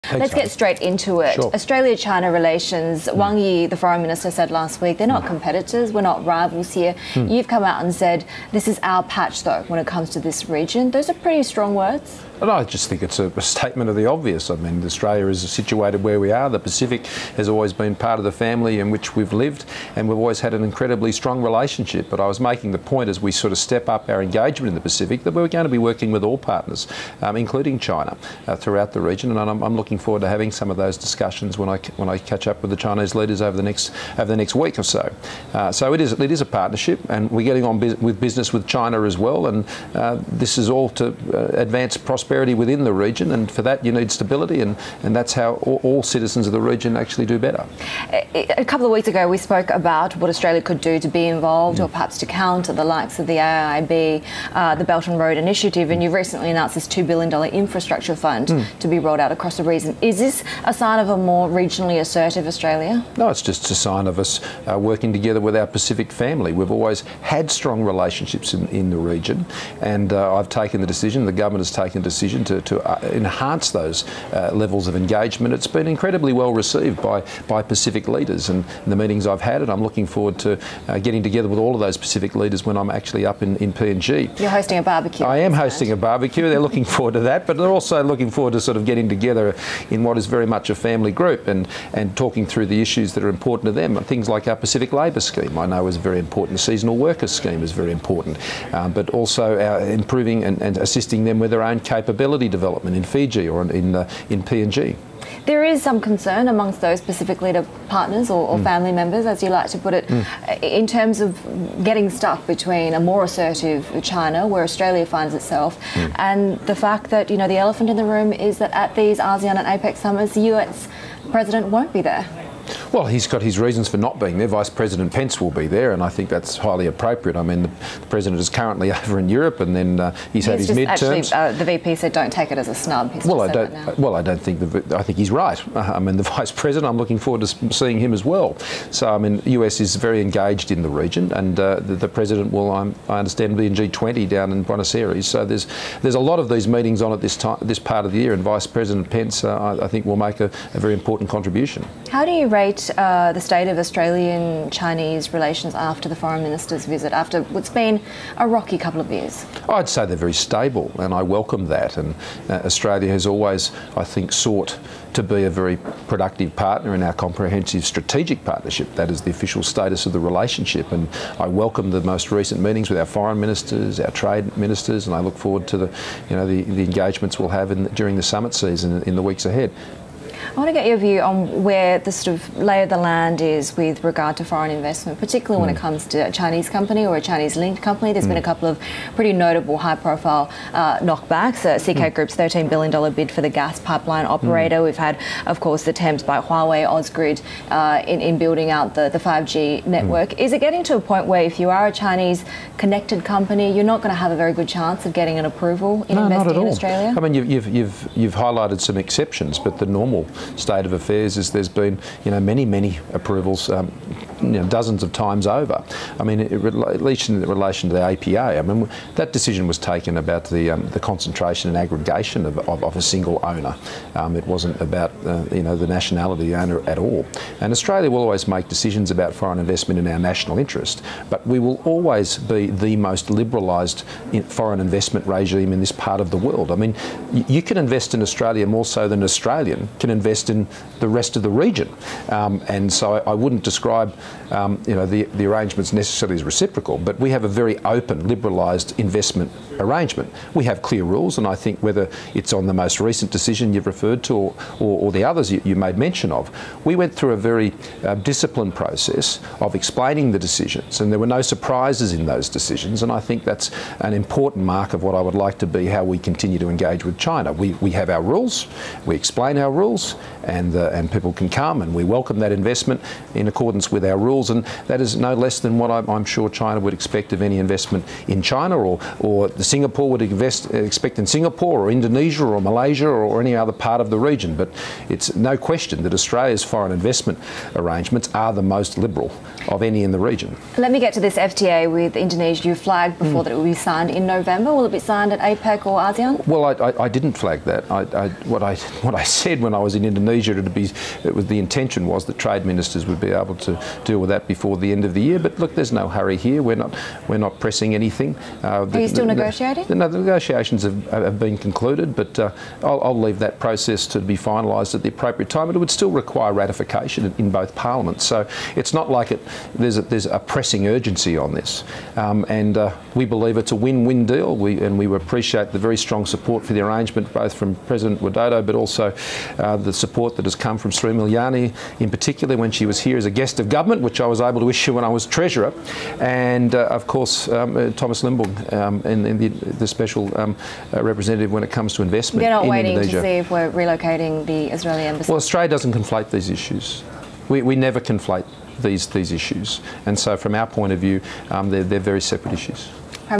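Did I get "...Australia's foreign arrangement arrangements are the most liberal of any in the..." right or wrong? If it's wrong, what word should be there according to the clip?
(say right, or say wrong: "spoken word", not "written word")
wrong: "investment", not "arrangement".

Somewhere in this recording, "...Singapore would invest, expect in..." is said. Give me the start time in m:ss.
4:39.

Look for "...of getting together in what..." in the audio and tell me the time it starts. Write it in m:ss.
1:28.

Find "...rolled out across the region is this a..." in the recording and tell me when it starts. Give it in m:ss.
0:58.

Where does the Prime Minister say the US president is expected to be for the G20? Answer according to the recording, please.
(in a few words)
Buenos Aires.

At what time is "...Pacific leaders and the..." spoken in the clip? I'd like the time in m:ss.
1:17.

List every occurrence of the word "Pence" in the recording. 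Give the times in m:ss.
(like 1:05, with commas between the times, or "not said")
2:05, 2:29.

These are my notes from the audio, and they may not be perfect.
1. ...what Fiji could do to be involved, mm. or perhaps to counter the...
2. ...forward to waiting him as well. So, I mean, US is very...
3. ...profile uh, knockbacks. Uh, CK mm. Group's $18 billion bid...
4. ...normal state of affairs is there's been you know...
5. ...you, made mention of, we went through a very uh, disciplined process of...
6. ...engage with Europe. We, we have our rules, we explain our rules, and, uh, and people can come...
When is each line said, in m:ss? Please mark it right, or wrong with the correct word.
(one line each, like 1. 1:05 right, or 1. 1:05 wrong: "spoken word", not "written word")
1. 0:50 wrong: "Australia", not "Fiji"
2. 2:17 wrong: "seeing", not "waiting"
3. 3:09 wrong: "13", not "18"
4. 3:29 right
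5. 4:15 right
6. 4:26 wrong: "China", not "Europe".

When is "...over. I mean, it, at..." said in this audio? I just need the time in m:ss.
3:35.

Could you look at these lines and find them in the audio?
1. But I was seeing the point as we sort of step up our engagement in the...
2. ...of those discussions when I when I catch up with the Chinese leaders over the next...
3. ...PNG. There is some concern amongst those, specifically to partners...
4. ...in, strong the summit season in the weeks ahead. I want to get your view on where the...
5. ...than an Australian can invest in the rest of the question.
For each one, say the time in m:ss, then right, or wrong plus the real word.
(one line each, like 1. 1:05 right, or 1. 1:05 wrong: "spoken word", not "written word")
1. 0:22 wrong: "making", not "seeing"
2. 0:30 right
3. 1:44 right
4. 2:57 wrong: "during", not "strong"
5. 3:59 wrong: "region", not "question".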